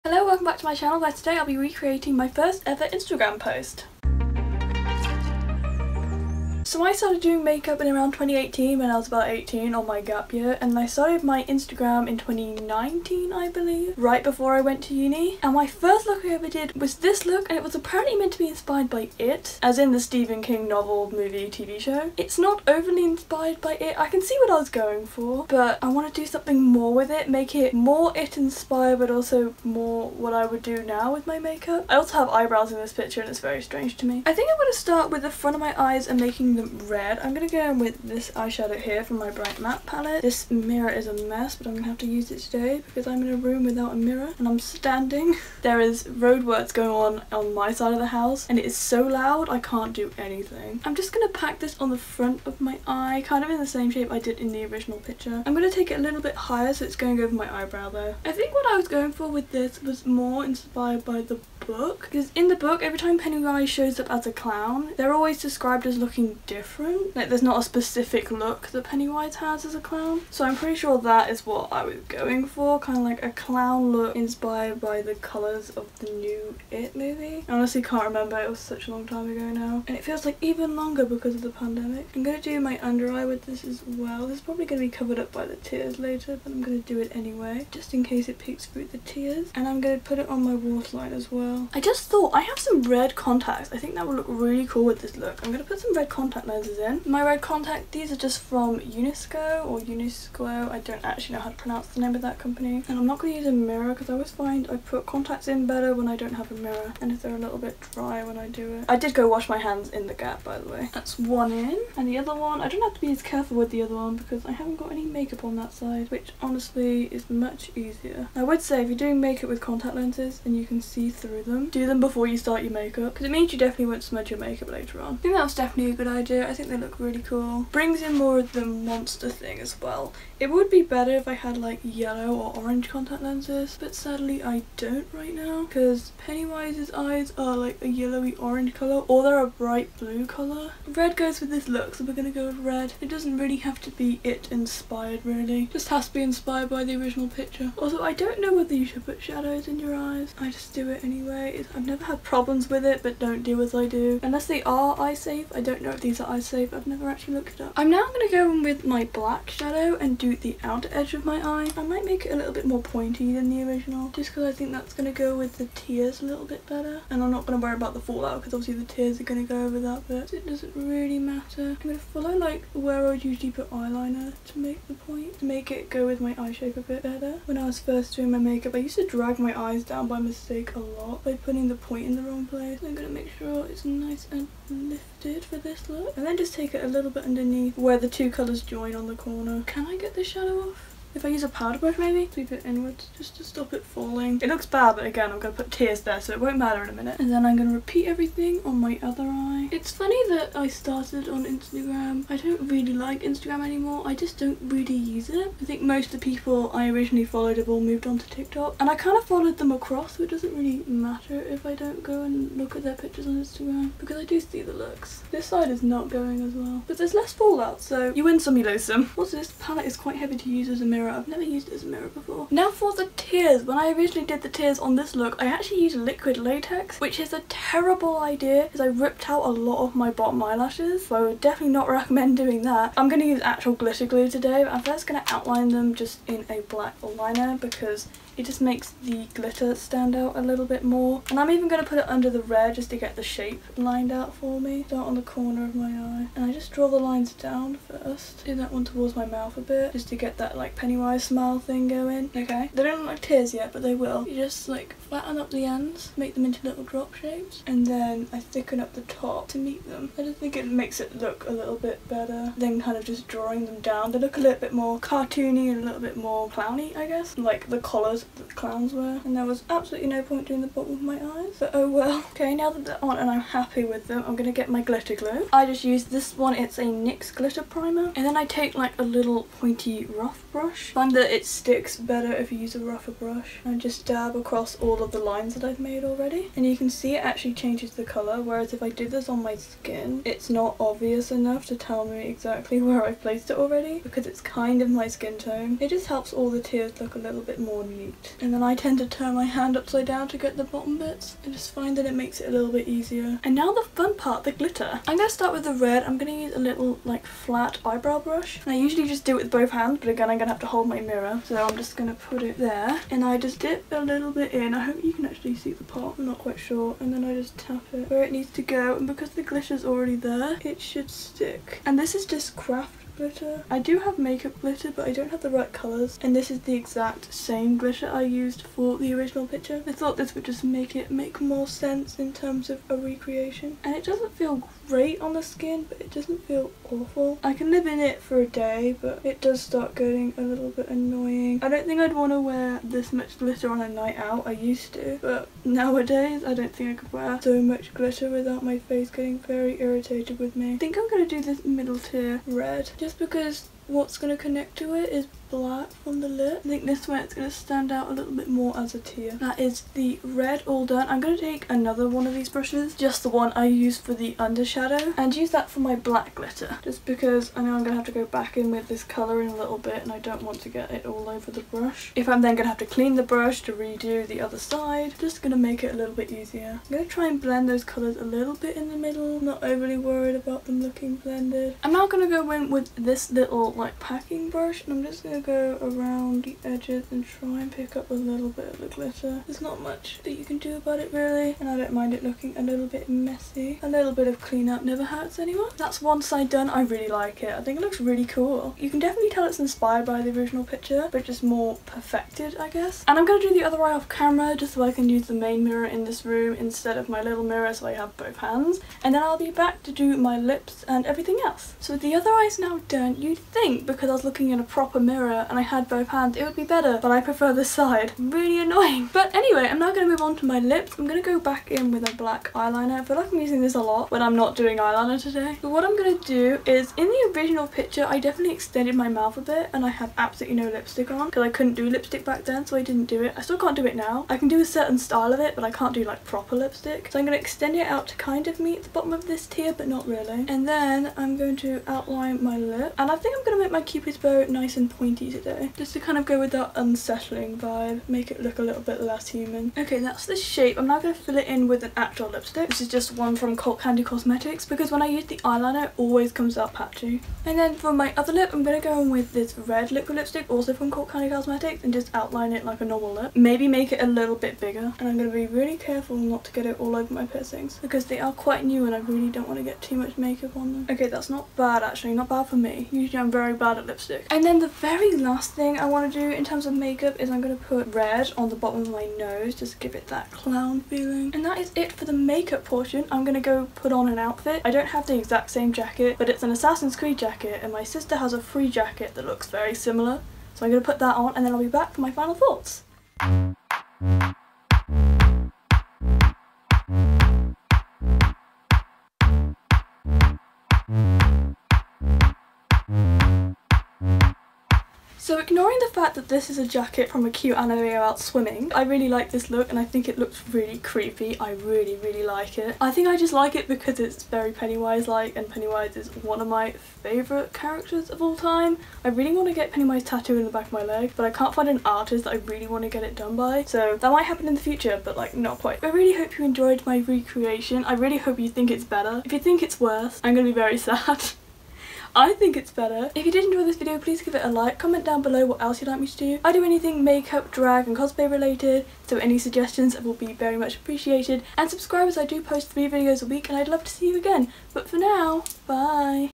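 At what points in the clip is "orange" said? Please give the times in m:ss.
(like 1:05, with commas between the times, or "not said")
2:12, 2:18.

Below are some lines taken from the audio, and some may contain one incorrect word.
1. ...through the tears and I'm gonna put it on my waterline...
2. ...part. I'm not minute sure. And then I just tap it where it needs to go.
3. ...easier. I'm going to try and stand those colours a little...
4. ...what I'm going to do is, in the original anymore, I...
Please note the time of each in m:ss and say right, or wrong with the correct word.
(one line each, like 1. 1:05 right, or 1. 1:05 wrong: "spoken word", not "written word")
1. 1:28 right
2. 5:15 wrong: "quite", not "minute"
3. 6:16 wrong: "blend", not "stand"
4. 7:05 wrong: "picture", not "anymore".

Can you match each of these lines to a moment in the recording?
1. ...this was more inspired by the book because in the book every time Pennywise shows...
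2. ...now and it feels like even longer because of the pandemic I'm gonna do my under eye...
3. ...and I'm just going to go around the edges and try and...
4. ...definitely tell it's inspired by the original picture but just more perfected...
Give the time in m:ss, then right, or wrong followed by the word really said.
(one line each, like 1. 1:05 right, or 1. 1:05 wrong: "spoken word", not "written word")
1. 0:59 right
2. 1:19 right
3. 6:24 right
4. 6:38 right.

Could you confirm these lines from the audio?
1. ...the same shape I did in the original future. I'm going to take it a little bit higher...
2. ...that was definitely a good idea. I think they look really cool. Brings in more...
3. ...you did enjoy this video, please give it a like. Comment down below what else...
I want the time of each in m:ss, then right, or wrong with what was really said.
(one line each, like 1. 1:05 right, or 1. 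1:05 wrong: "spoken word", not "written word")
1. 0:53 wrong: "picture", not "future"
2. 2:05 right
3. 8:53 right.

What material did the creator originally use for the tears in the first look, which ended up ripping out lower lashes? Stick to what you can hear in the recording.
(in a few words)
liquid latex.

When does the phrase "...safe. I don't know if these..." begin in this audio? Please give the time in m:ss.
2:35.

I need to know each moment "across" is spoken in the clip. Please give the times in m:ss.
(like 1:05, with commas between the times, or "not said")
3:29, 4:44.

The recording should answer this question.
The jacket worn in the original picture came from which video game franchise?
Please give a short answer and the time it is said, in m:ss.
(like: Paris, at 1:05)
Assassin's Creed, at 8:06.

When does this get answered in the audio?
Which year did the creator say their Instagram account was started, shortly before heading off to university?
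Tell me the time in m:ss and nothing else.
0:12.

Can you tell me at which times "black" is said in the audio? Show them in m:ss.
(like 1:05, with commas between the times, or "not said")
2:39, 3:56, 5:55, 6:05, 7:02.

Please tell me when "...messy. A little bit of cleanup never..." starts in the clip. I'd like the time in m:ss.
6:33.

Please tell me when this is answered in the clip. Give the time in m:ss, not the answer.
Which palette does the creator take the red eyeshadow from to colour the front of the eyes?
0:39.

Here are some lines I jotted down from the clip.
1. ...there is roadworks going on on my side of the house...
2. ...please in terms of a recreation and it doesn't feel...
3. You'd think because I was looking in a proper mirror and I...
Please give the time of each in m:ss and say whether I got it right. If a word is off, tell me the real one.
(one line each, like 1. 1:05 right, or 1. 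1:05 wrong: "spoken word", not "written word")
1. 0:45 right
2. 5:31 wrong: "sense", not "please"
3. 6:53 right.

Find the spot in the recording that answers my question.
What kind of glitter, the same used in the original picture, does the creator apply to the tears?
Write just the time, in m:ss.
5:22.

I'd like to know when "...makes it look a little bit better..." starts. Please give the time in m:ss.
4:20.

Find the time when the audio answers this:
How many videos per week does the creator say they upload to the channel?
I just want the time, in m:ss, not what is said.
9:02.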